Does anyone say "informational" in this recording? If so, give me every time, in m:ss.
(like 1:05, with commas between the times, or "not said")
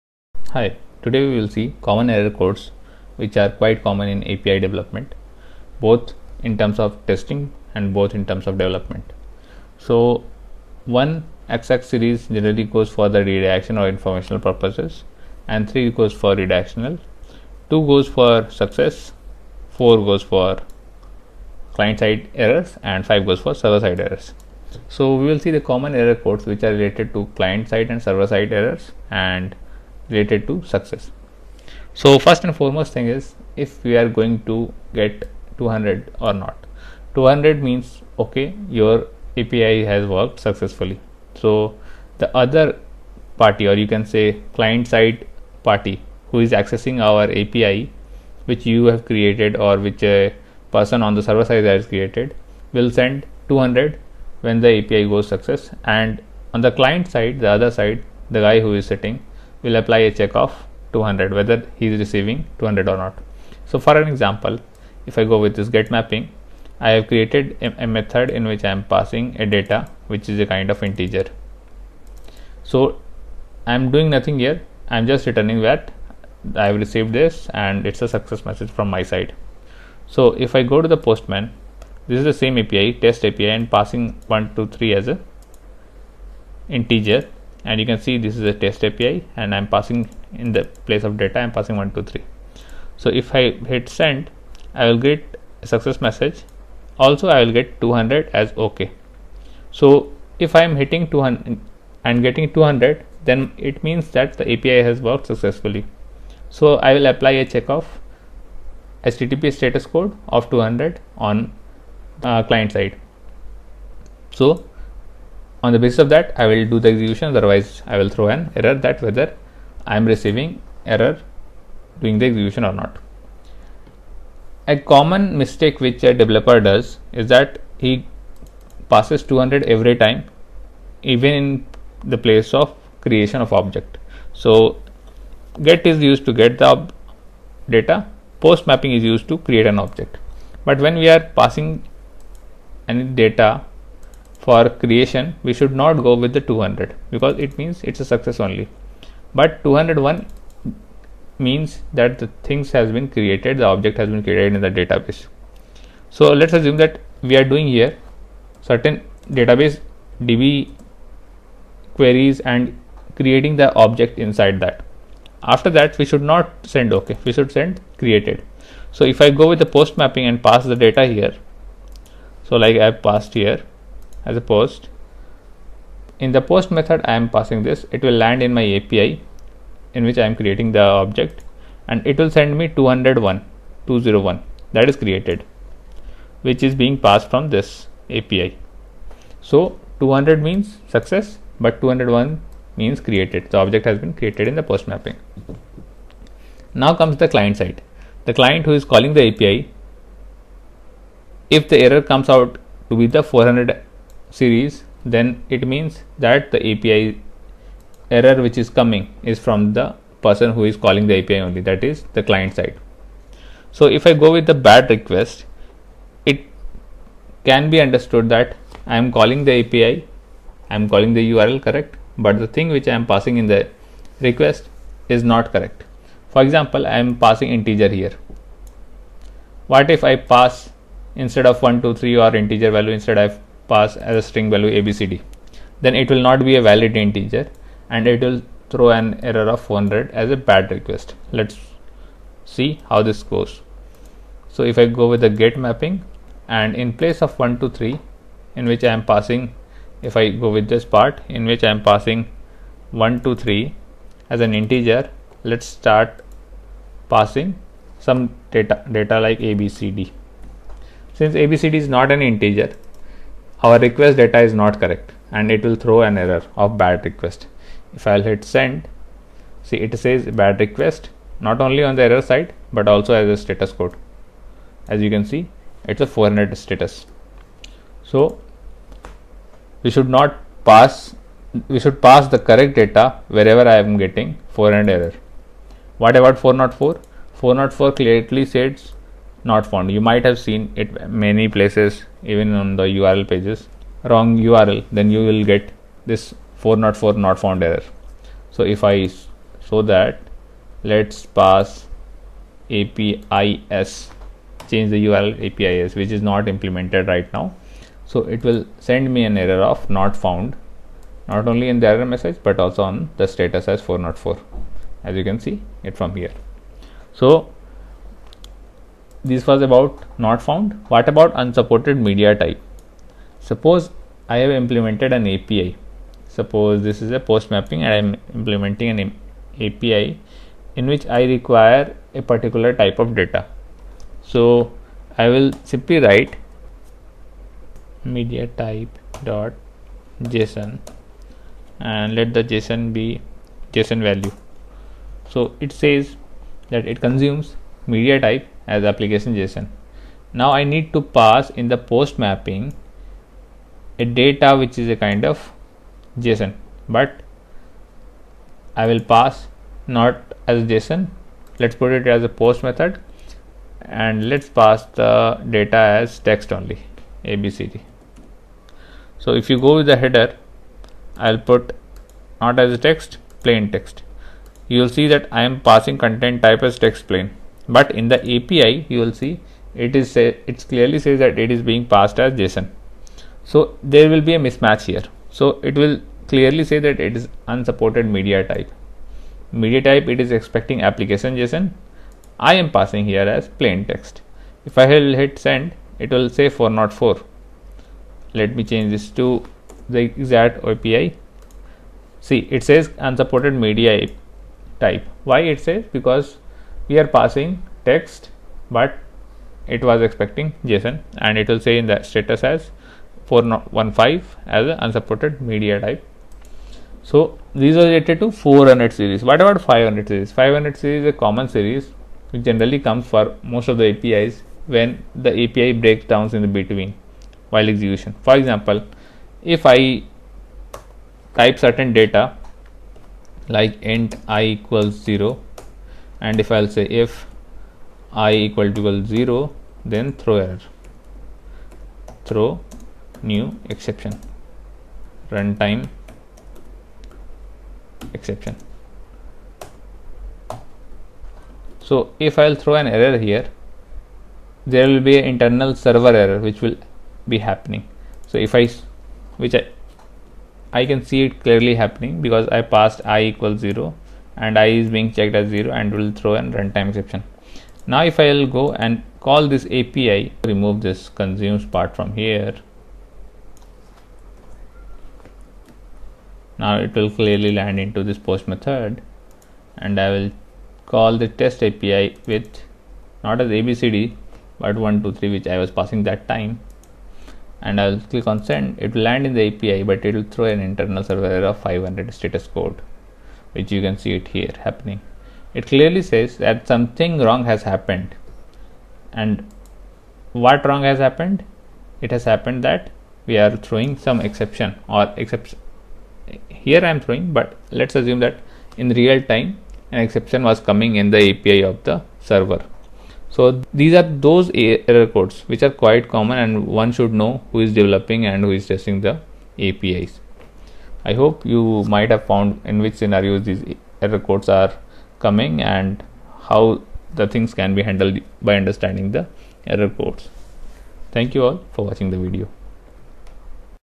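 0:13.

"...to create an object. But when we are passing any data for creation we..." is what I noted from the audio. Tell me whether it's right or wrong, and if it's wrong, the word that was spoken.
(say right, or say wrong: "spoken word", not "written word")
right.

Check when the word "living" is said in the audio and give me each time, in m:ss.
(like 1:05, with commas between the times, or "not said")
not said.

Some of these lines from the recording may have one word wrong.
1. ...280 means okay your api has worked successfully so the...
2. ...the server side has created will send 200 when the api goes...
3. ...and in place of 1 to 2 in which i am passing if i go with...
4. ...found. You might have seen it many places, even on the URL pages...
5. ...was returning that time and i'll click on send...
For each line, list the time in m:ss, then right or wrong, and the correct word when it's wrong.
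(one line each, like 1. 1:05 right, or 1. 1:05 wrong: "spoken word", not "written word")
1. 0:37 wrong: "200", not "280"
2. 0:51 right
3. 4:06 wrong: "3", not "2"
4. 4:49 right
5. 8:05 wrong: "passing", not "returning".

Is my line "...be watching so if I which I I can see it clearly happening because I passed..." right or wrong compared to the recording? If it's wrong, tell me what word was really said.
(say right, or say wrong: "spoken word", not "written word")
wrong: "happening", not "watching".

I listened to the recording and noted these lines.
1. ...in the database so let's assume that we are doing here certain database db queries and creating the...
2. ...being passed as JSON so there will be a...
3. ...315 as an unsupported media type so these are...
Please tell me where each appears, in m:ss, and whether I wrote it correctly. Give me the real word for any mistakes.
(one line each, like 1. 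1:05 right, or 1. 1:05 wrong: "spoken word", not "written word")
1. 2:34 right
2. 6:21 right
3. 6:53 wrong: "415", not "315".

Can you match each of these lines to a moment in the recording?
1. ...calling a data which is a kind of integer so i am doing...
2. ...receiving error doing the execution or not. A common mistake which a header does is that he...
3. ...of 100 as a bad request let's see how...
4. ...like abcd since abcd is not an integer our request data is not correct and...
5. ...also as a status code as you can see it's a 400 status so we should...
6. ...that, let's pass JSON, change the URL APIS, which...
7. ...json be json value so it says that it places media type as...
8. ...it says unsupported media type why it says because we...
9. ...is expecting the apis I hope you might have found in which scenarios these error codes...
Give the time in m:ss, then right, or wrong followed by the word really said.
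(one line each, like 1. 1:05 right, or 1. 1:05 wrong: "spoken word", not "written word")
1. 1:08 wrong: "passing", not "calling"
2. 2:00 wrong: "developer", not "header"
3. 3:59 right
4. 4:19 right
5. 4:32 right
6. 4:59 wrong: "APIS", not "JSON"
7. 5:42 wrong: "consumes", not "places"
8. 6:42 right
9. 8:38 wrong: "testing", not "expecting".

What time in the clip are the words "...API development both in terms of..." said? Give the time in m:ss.
0:04.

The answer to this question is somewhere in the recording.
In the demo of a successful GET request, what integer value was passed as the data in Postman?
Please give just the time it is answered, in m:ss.
1:31.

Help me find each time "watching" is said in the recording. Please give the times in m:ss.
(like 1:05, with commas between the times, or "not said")
8:51.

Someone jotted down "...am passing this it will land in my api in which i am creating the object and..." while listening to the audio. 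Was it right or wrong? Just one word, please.
right.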